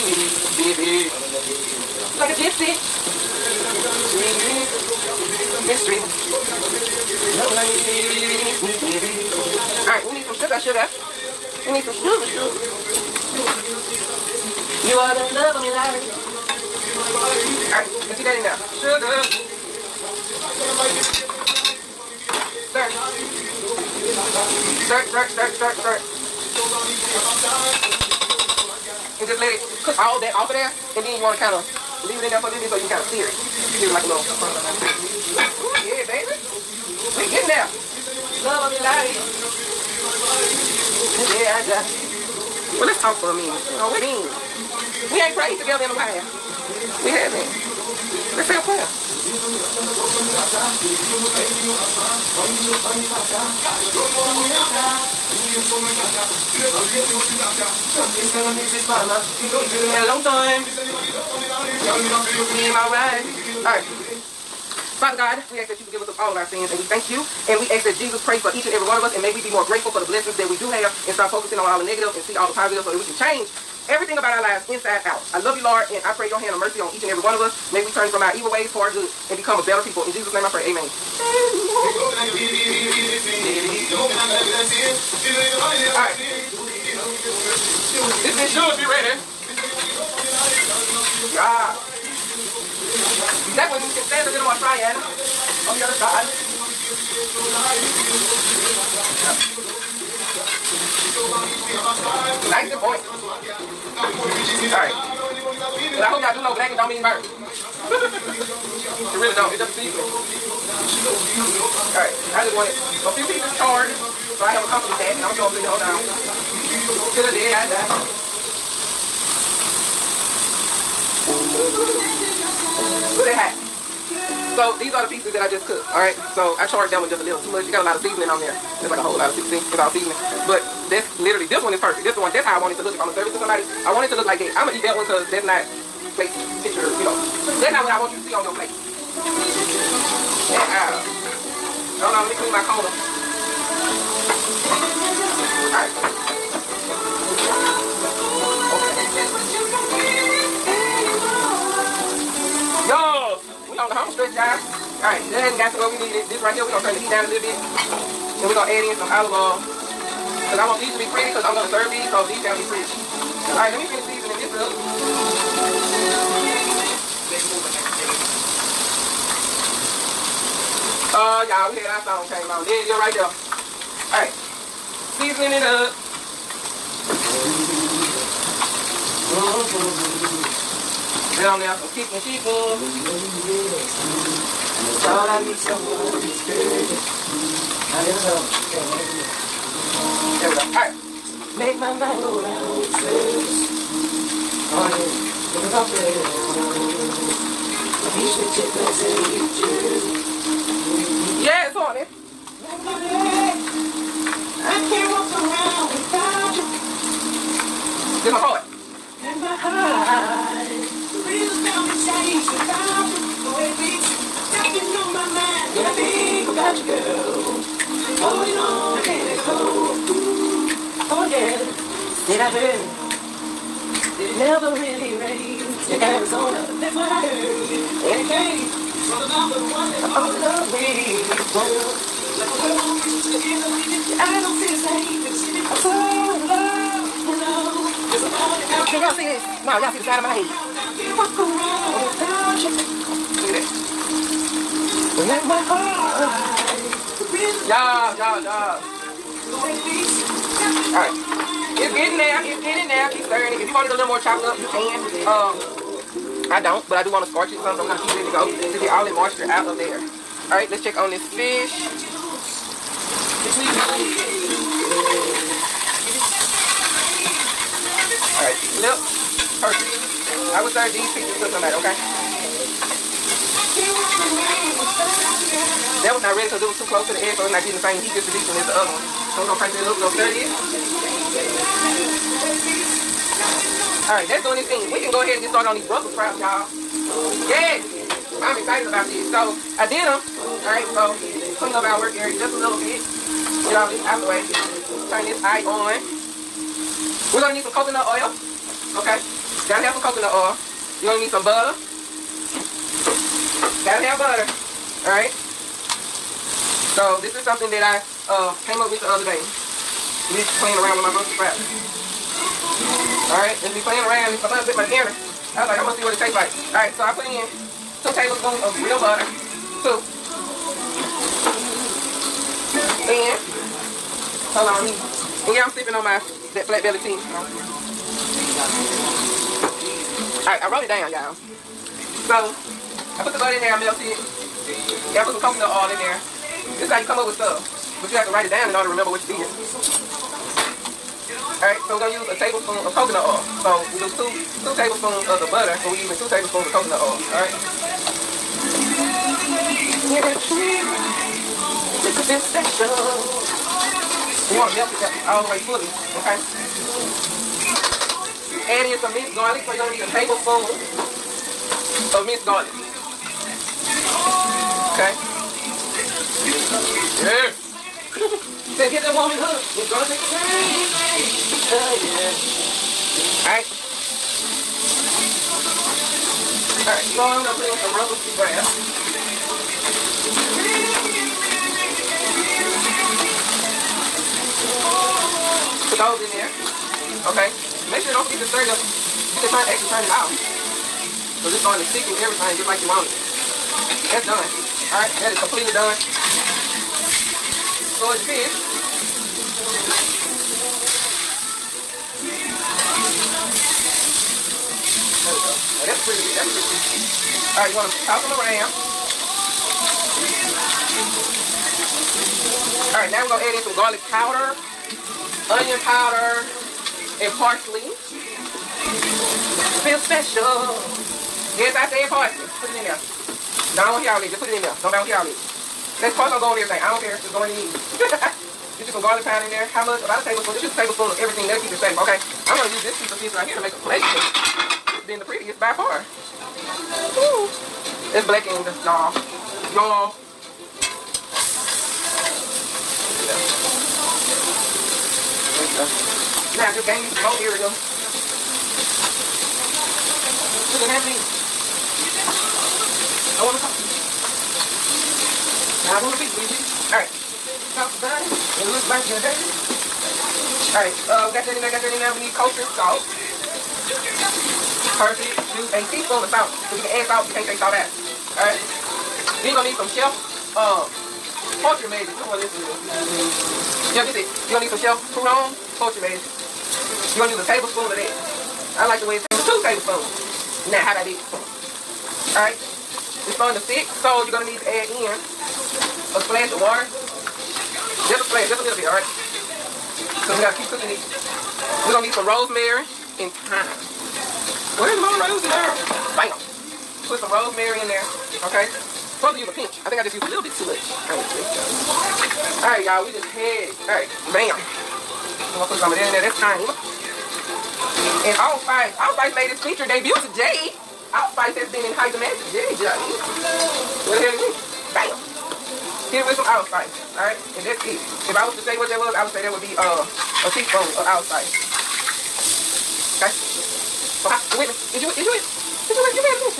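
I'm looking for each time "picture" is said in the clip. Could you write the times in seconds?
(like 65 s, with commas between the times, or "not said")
136 s.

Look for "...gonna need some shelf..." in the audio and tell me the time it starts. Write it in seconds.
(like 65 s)
474 s.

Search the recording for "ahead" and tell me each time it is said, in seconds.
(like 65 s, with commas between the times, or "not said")
285 s.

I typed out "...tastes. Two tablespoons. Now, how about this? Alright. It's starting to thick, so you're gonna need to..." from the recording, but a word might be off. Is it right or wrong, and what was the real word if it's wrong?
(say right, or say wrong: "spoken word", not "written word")
right.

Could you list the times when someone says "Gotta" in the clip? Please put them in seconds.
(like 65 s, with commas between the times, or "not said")
299 s, 303 s.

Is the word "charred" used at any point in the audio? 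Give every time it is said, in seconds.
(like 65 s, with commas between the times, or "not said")
113 s, 126 s.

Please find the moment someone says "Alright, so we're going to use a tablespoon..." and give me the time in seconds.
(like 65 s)
341 s.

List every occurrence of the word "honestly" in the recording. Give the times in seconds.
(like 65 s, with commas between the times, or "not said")
501 s.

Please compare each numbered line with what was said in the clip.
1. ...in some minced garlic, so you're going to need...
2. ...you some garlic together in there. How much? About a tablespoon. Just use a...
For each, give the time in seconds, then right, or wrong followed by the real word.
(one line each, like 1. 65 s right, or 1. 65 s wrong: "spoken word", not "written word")
1. 358 s right
2. 428 s wrong: "powder", not "together".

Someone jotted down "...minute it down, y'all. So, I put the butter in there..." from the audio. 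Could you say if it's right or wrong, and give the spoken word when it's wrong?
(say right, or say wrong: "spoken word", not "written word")
wrong: "wrote", not "minute".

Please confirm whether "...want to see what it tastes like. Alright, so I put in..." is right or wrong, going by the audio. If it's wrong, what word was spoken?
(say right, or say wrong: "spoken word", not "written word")
right.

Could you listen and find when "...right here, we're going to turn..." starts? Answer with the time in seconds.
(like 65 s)
156 s.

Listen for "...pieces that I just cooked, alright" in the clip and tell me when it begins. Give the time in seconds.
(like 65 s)
125 s.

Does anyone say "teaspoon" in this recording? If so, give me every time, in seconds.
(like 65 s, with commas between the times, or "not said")
465 s, 520 s.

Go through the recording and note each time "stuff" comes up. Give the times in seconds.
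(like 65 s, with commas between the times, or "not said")
337 s.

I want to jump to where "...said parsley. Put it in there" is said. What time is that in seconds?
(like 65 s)
421 s.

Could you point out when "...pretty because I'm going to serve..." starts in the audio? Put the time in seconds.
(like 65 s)
161 s.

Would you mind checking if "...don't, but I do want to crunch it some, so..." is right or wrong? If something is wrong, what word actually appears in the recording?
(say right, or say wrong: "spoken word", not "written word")
wrong: "scorch", not "crunch".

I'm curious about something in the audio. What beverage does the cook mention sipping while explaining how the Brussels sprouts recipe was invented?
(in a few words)
flat belly tea.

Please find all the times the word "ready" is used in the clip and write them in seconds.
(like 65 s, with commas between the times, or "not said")
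88 s, 276 s.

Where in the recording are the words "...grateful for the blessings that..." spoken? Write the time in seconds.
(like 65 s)
69 s.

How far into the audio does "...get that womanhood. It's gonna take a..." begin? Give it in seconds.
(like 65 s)
368 s.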